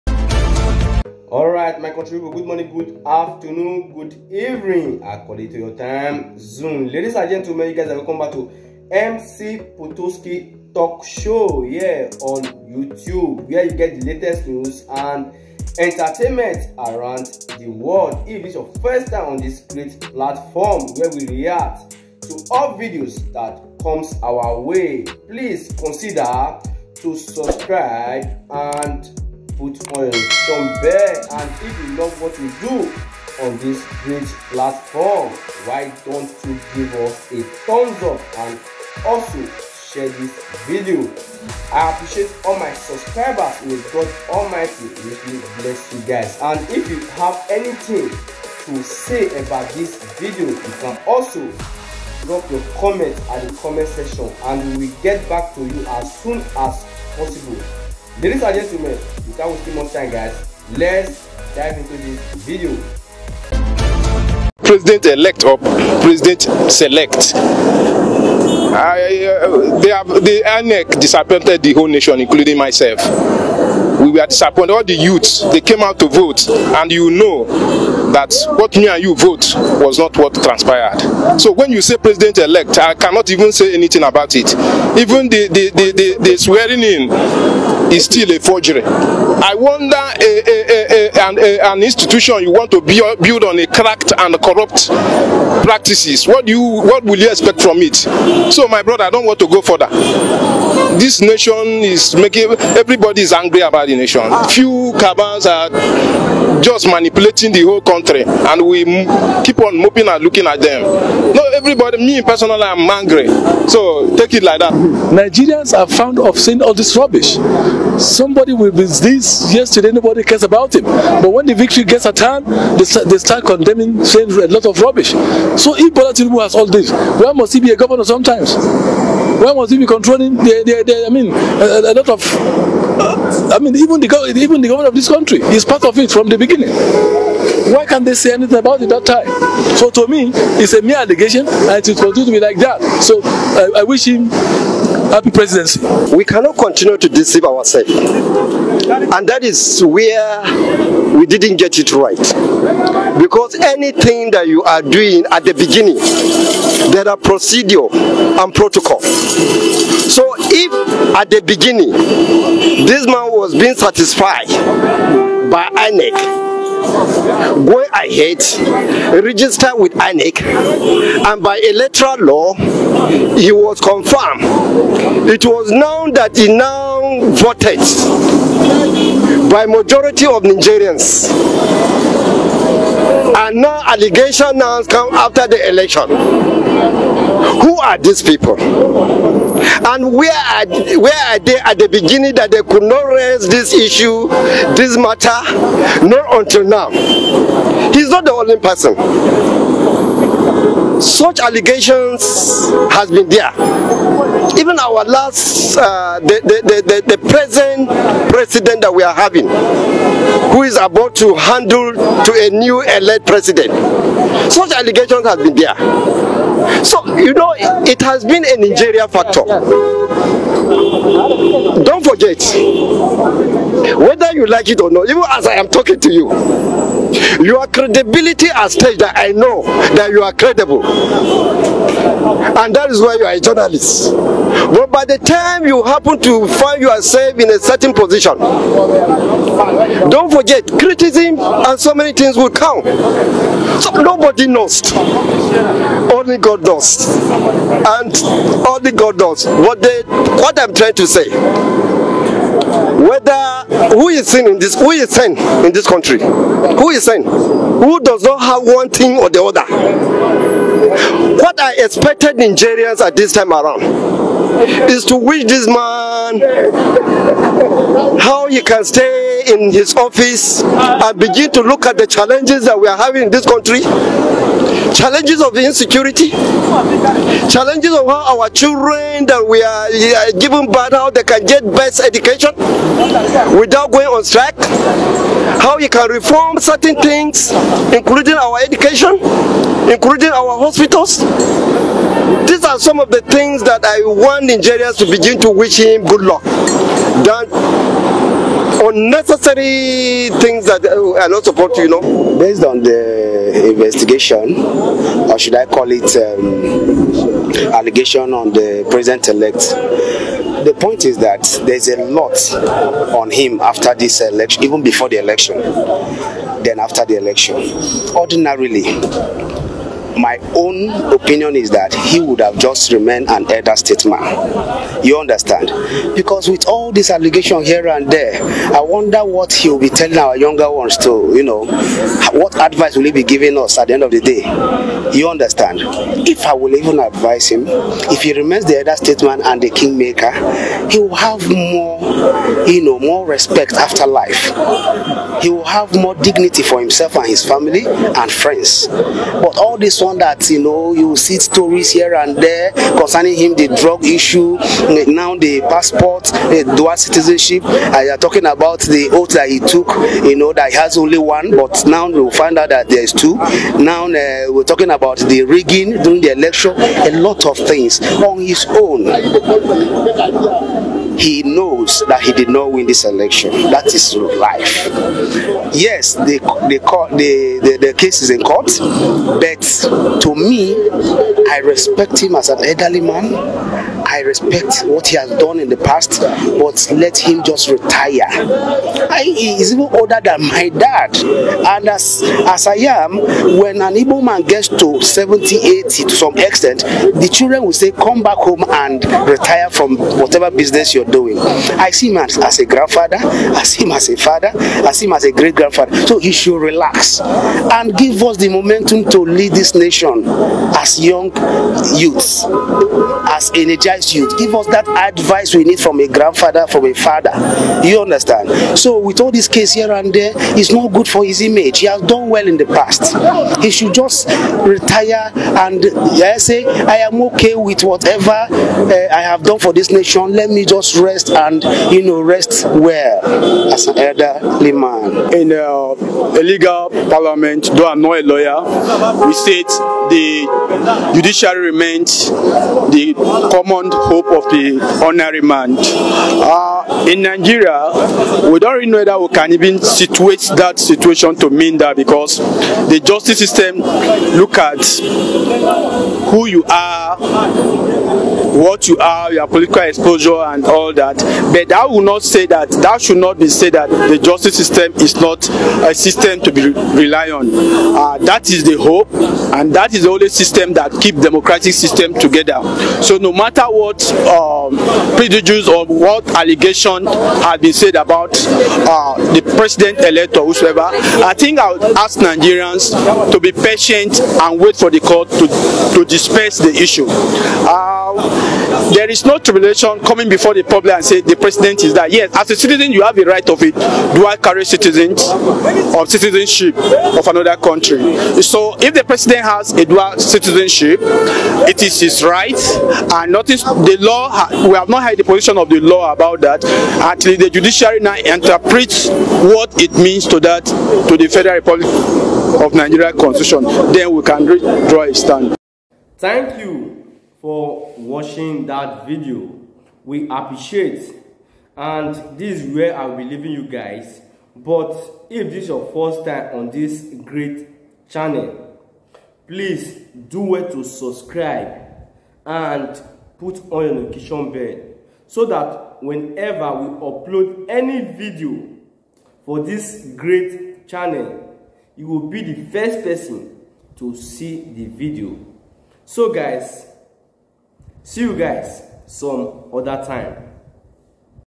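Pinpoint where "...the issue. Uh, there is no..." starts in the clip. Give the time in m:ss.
8:06.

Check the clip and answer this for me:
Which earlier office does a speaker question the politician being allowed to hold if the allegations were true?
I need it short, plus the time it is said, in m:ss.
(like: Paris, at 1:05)
Governor, at 2:07.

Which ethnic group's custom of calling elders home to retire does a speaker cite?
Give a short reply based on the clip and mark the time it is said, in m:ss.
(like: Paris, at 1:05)
Igbo, at 6:33.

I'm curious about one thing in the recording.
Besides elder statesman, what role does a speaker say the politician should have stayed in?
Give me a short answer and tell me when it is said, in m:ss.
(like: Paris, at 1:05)
Kingmaker, at 5:39.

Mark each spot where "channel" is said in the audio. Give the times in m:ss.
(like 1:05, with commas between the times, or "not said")
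8:48, 9:00.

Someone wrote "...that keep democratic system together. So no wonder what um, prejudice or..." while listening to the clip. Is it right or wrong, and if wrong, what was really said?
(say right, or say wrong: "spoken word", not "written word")
wrong: "matter", not "wonder".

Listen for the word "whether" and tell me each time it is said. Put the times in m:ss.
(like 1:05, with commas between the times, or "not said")
3:43, 4:13, 7:28.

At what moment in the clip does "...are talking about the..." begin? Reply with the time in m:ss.
5:58.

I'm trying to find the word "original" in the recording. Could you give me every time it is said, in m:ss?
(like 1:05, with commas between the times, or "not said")
not said.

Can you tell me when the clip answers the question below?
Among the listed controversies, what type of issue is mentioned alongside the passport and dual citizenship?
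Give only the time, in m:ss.
5:53.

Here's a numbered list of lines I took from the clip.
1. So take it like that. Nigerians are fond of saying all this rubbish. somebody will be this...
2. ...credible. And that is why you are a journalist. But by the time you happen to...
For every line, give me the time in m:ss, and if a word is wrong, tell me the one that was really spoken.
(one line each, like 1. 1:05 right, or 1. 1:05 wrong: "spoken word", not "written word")
1. 1:53 right
2. 3:50 right.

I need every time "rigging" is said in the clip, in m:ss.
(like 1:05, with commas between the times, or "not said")
6:05.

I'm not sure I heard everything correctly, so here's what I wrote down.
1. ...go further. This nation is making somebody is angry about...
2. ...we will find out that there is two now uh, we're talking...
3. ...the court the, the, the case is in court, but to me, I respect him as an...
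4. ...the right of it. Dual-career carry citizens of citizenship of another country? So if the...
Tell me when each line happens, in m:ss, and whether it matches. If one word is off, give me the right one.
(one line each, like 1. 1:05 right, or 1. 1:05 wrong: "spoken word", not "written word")
1. 1:39 wrong: "everybody", not "somebody"
2. 6:02 right
3. 6:16 right
4. 8:13 right.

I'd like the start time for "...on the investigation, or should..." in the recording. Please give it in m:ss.
5:02.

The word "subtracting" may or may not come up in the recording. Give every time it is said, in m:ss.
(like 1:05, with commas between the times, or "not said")
not said.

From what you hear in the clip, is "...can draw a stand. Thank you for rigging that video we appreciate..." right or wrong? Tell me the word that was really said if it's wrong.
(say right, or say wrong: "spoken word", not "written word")
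wrong: "watching", not "rigging".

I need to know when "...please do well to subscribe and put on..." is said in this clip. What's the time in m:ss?
8:49.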